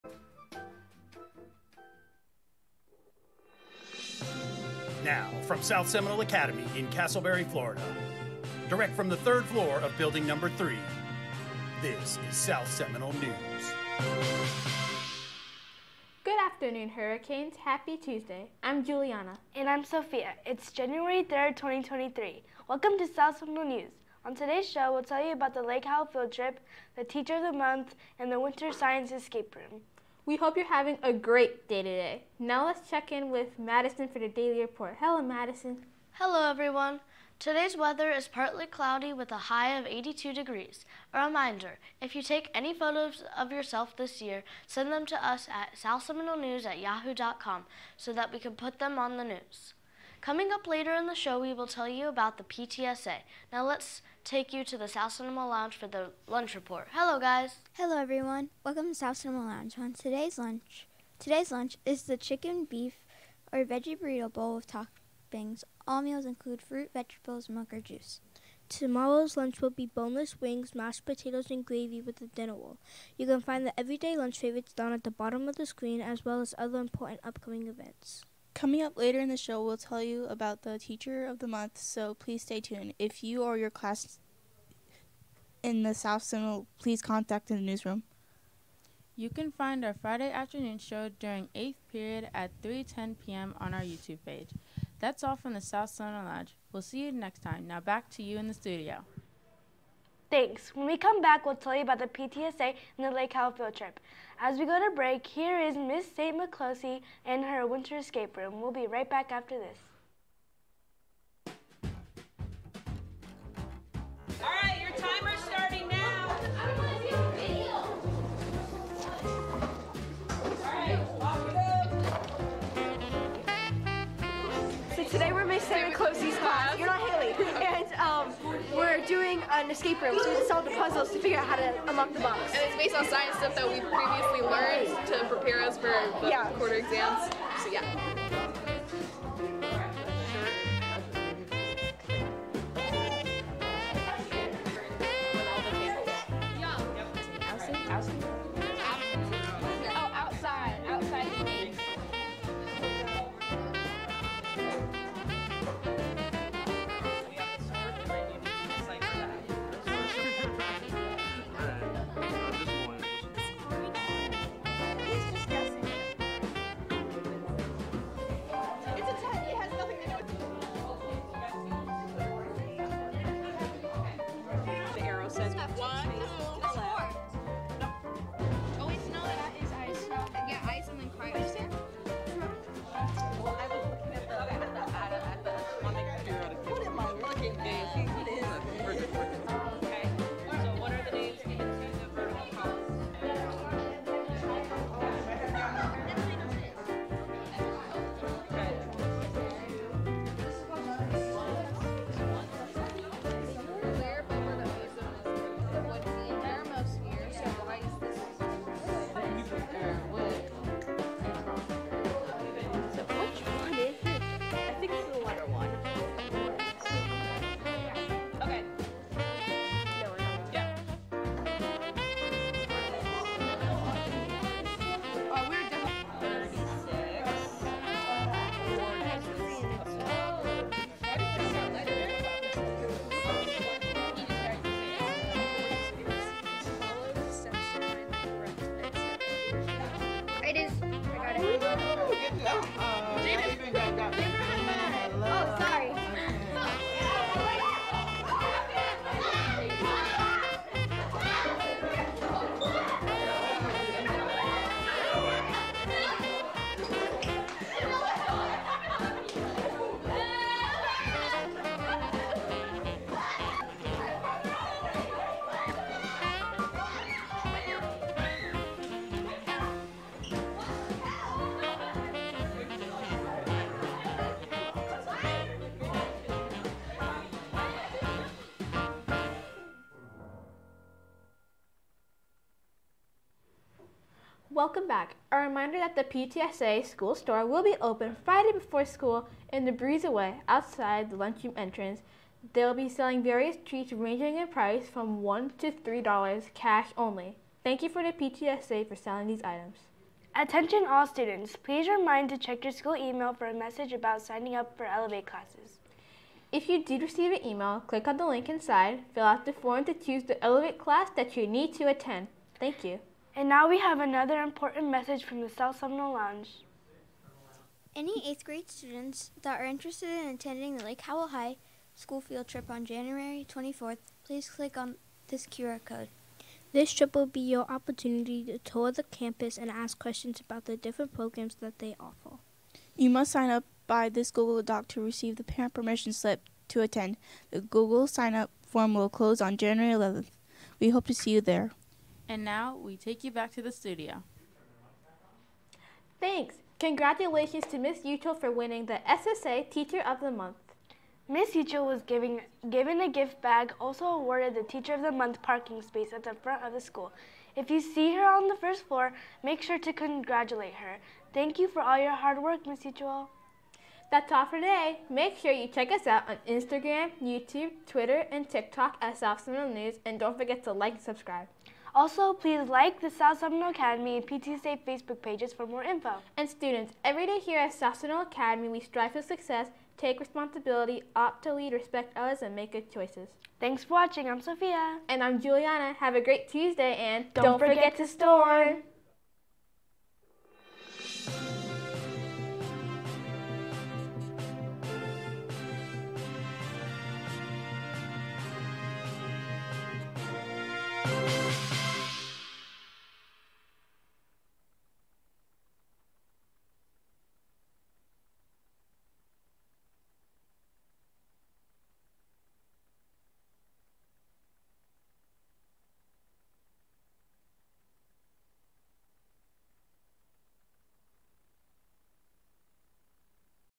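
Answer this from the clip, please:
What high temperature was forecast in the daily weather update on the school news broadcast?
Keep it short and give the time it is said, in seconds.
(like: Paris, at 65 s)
82 degrees, at 39 s.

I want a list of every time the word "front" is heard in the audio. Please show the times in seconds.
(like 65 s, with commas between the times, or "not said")
356 s.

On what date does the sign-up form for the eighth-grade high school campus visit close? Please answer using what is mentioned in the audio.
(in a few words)
January 11.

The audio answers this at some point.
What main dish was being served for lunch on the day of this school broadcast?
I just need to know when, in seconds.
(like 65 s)
63 s.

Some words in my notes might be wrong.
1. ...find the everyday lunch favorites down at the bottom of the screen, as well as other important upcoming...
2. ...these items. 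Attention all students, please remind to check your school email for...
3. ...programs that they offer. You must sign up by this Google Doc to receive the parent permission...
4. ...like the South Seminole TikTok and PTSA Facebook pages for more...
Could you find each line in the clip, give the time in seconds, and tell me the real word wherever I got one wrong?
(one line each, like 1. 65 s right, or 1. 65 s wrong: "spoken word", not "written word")
1. 73 s right
2. 299 s right
3. 331 s right
4. 372 s wrong: "Academy", not "TikTok".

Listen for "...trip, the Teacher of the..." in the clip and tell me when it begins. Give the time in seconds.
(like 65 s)
26 s.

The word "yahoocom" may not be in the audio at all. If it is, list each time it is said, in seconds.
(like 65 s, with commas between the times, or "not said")
46 s.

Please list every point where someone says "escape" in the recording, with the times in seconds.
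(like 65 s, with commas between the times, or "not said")
29 s, 107 s, 129 s.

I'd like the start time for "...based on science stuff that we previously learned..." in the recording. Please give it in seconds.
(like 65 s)
132 s.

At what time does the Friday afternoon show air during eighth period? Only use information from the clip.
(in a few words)
3:10 p.m.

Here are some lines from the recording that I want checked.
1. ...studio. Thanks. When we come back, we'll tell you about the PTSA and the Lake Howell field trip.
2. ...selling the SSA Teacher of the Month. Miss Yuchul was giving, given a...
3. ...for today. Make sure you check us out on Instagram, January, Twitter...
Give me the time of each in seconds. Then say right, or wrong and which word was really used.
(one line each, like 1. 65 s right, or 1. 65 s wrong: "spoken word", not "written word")
1. 98 s right
2. 348 s wrong: "winning", not "selling"
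3. 364 s wrong: "YouTube", not "January".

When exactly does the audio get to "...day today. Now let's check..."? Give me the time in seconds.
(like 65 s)
31 s.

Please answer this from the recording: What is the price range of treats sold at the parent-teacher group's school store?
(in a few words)
$1 to $3.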